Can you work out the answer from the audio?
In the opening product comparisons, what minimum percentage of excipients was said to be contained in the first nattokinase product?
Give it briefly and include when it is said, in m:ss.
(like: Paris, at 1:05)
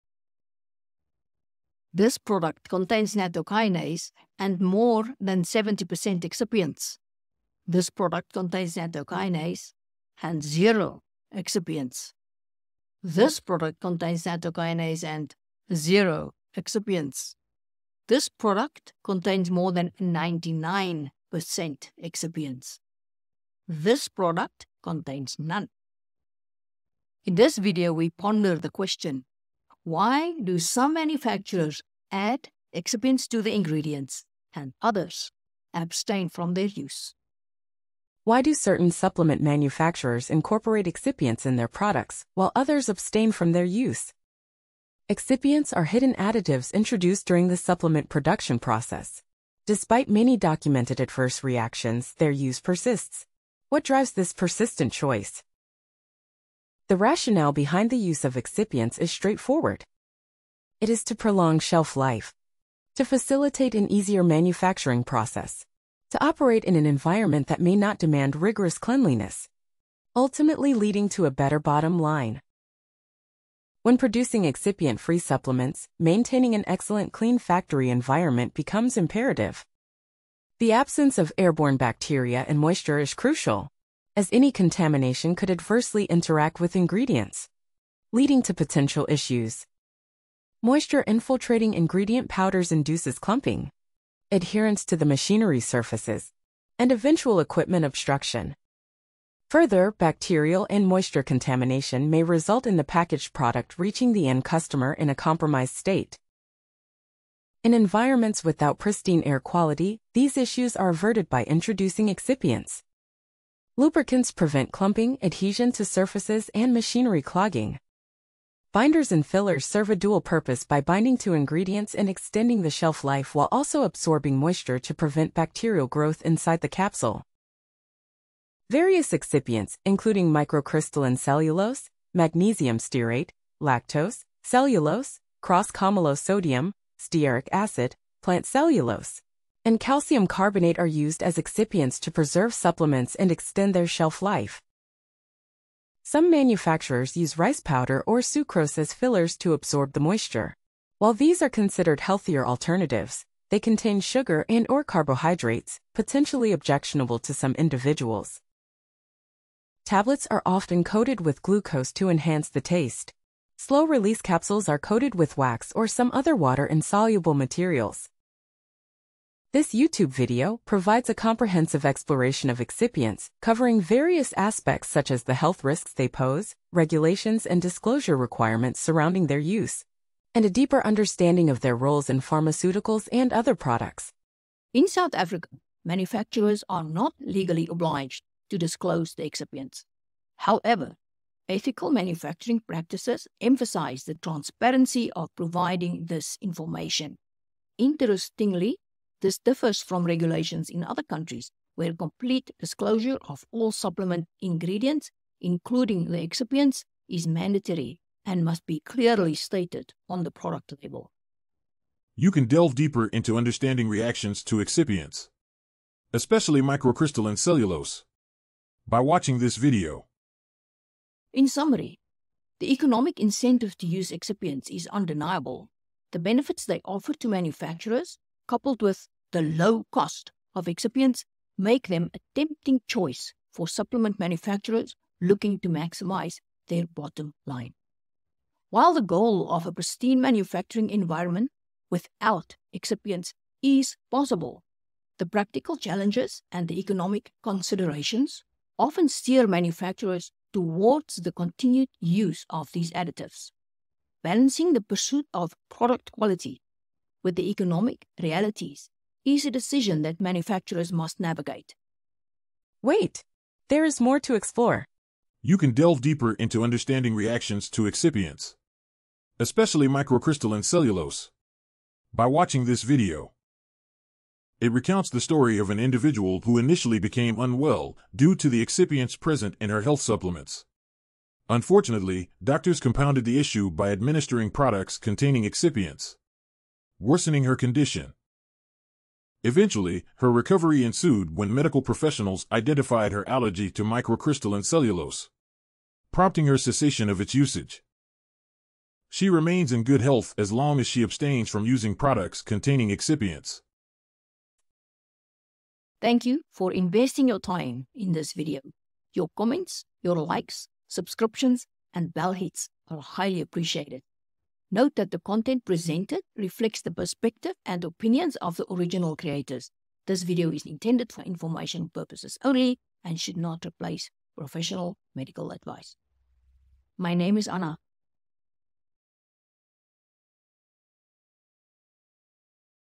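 70%, at 0:05.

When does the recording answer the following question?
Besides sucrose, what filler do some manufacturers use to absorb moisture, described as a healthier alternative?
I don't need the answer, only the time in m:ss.
2:27.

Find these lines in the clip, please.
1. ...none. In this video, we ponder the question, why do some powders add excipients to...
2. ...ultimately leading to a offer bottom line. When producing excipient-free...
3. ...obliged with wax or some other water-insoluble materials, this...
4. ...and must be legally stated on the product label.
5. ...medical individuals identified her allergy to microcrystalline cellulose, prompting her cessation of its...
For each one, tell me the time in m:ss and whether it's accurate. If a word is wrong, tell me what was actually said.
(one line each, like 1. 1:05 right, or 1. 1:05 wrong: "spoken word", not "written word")
1. 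0:25 wrong: "manufacturers", not "powders"
2. 1:10 wrong: "better", not "offer"
3. 2:44 wrong: "coated", not "obliged"
4. 3:28 wrong: "clearly", not "legally"
5. 4:51 wrong: "professionals", not "individuals".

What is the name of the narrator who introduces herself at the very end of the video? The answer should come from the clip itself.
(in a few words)
Anna.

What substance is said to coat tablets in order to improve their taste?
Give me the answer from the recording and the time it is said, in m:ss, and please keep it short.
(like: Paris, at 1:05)
Glucose, at 2:41.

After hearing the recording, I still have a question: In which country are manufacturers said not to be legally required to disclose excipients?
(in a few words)
South Africa.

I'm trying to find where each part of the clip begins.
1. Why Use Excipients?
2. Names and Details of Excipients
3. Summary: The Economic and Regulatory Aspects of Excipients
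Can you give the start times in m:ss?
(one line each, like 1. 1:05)
1. 0:45
2. 2:08
3. 3:41.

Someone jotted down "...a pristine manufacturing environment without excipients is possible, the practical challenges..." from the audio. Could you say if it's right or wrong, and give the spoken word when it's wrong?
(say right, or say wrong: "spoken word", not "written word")
right.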